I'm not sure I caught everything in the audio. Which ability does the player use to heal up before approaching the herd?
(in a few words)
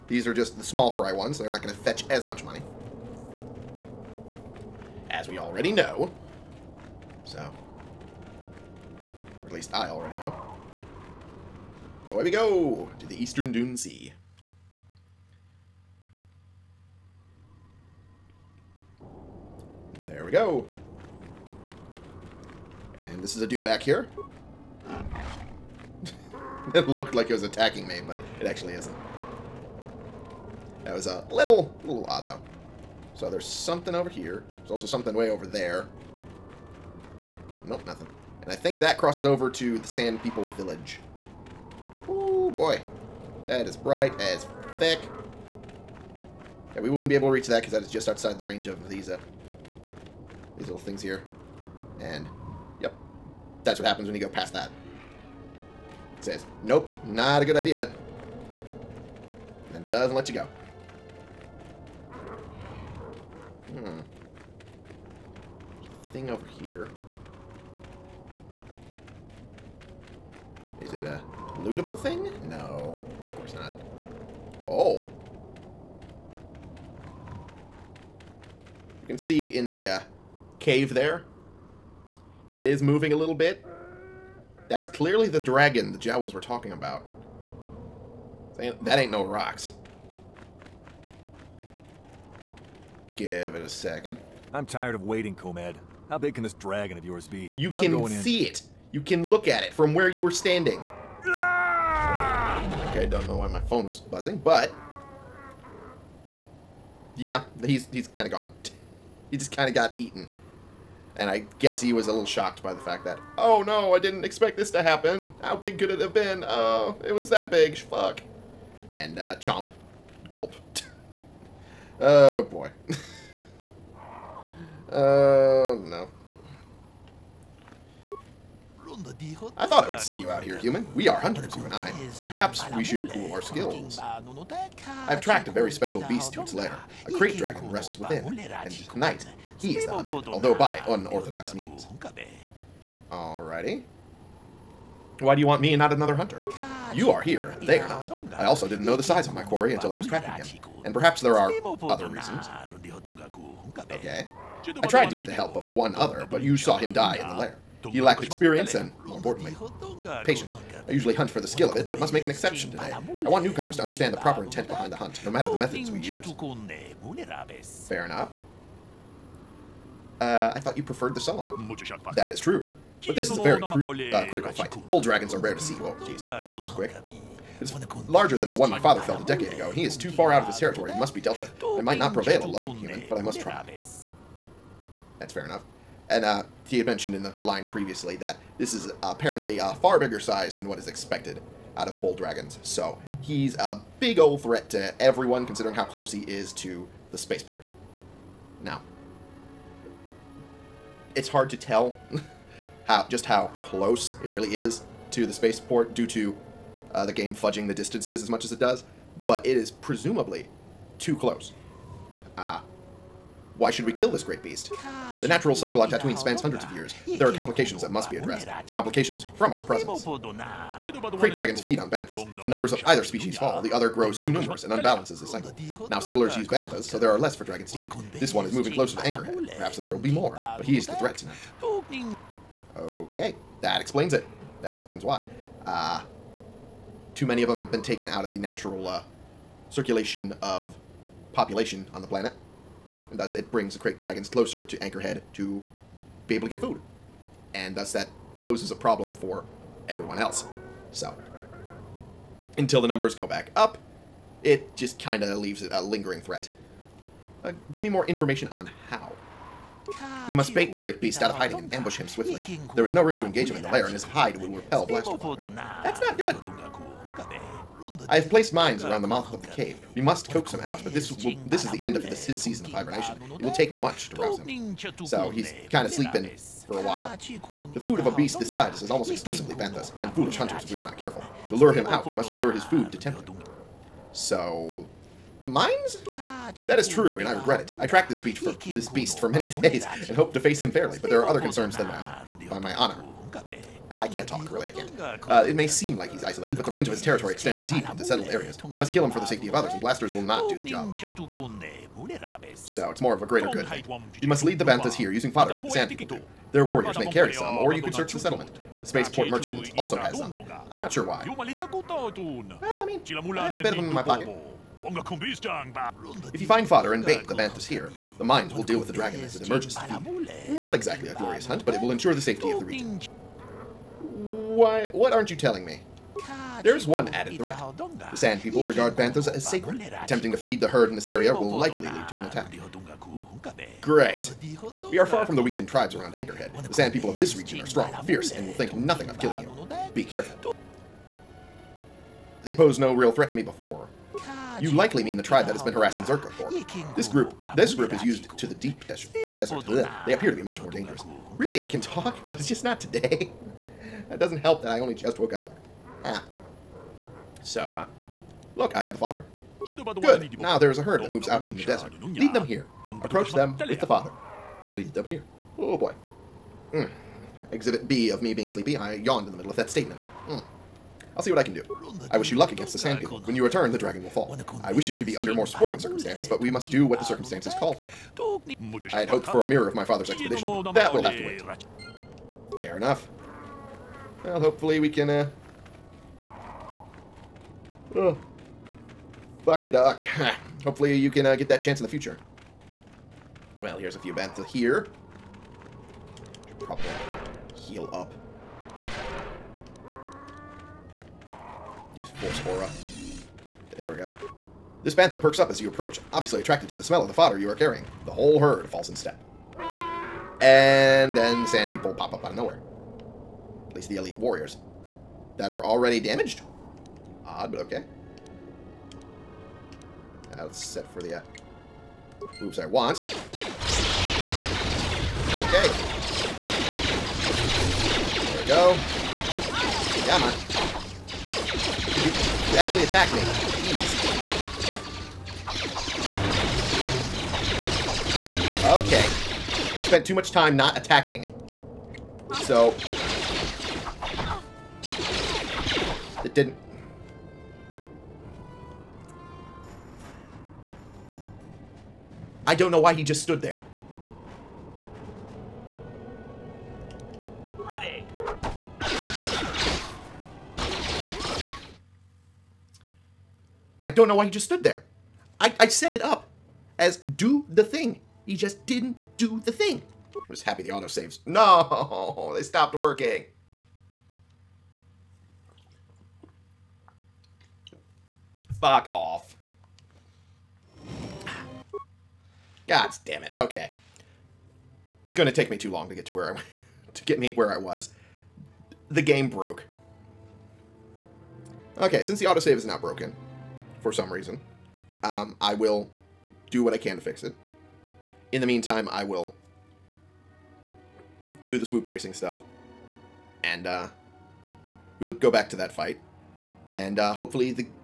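force aura.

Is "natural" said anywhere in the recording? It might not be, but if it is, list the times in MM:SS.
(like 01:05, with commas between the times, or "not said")
03:35, 03:58.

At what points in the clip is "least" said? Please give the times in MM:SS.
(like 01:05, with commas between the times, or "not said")
00:09, 06:53.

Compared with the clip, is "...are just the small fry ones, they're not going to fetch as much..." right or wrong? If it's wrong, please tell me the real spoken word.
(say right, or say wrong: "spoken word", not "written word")
right.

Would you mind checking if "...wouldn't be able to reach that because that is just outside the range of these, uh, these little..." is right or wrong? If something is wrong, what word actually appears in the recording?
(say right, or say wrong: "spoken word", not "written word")
right.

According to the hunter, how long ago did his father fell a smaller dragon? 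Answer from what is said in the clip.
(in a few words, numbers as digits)
a decade ago.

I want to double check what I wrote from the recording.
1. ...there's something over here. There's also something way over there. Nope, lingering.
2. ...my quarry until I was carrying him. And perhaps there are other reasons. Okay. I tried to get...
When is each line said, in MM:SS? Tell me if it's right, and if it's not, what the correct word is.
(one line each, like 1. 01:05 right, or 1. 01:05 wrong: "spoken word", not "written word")
1. 00:33 wrong: "nothing", not "lingering"
2. 02:29 wrong: "tracking", not "carrying".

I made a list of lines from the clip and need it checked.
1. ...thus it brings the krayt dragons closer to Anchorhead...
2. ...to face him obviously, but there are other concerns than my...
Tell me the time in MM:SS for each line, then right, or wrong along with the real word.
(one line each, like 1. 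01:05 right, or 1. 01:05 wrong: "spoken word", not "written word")
1. 04:03 right
2. 04:50 wrong: "fairly", not "obviously".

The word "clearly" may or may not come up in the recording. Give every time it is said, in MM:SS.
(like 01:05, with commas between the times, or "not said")
01:24.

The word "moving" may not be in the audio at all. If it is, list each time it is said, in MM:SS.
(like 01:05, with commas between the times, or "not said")
01:22, 03:48.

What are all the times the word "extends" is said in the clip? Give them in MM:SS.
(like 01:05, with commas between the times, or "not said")
04:57.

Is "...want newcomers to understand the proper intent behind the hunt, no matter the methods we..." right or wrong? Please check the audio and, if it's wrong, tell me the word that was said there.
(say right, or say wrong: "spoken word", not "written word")
right.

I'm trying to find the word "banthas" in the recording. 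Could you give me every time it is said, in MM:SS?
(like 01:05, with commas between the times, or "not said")
03:41, 03:46, 04:39, 05:04, 05:17, 05:28, 06:34, 06:44.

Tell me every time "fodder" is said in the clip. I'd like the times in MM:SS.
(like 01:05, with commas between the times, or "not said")
05:05, 05:16, 05:58, 06:47.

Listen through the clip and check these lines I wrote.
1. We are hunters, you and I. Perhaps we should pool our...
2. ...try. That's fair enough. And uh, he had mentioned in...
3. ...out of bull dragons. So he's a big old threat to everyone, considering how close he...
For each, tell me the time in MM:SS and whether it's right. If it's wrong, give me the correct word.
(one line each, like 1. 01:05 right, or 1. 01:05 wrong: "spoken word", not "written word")
1. 02:10 right
2. 03:03 right
3. 03:11 right.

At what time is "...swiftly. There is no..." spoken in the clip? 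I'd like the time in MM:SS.
04:22.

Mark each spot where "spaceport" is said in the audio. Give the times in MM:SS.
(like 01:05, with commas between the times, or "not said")
03:17, 03:25, 05:08.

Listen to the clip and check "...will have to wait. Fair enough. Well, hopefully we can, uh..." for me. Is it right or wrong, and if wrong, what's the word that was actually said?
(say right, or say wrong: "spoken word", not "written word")
right.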